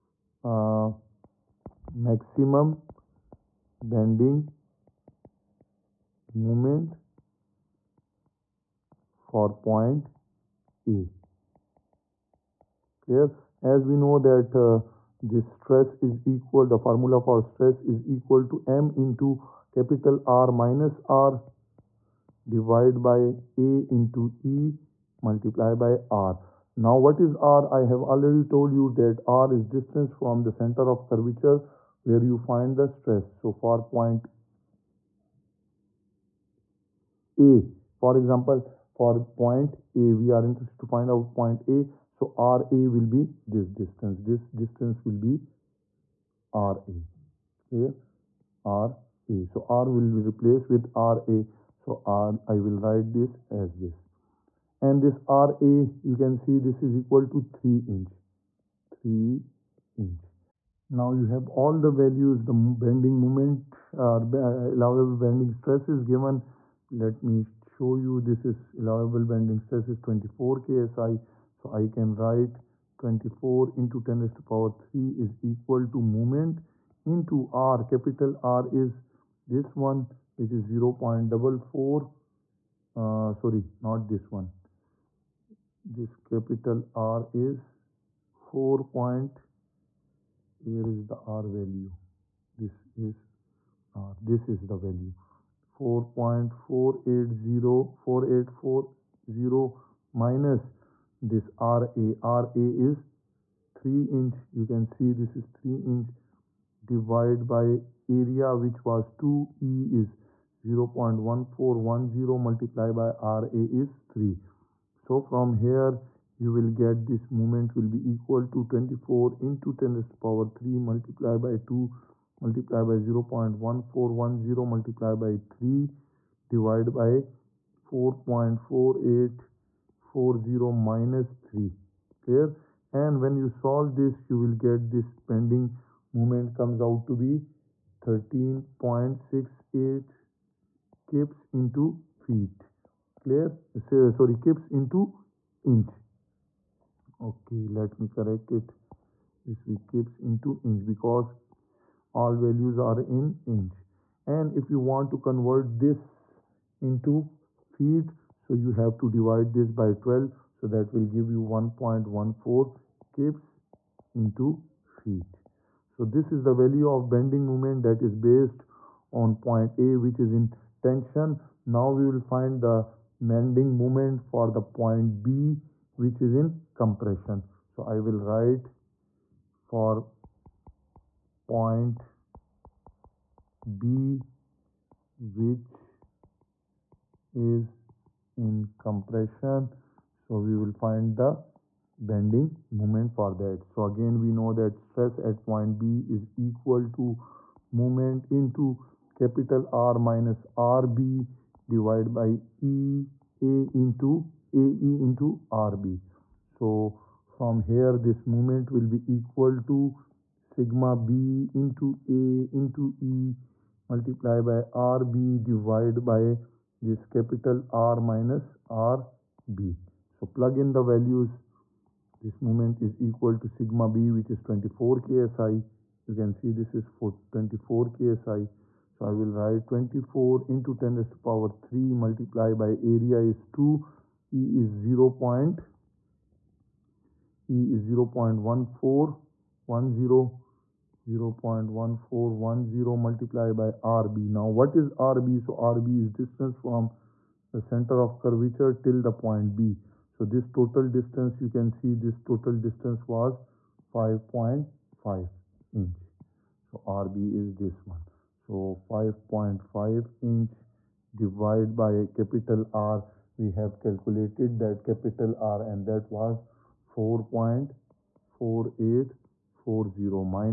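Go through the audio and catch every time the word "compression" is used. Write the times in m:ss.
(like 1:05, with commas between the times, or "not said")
2:56, 3:08.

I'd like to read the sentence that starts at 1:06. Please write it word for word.
Let me show you this is allowable bending stress is 24 KSI.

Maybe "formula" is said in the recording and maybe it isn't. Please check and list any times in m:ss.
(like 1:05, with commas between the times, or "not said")
0:16.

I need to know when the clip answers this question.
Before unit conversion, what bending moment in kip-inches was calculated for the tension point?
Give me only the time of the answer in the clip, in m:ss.
2:18.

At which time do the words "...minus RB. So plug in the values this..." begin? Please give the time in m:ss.
3:38.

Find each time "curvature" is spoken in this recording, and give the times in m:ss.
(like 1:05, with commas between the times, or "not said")
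0:31, 4:08.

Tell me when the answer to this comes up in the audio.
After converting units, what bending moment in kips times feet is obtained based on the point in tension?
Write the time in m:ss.
2:41.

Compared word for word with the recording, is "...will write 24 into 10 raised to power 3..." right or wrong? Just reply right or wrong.
right.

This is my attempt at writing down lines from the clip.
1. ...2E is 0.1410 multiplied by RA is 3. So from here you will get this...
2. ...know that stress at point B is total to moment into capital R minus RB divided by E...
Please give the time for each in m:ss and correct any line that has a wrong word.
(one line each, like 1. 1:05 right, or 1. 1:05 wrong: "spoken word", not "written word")
1. 1:49 right
2. 3:14 wrong: "equal", not "total".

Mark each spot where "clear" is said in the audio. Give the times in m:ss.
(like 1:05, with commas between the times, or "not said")
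0:13, 0:47, 2:12, 2:23.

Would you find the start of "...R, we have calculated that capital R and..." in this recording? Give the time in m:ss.
4:22.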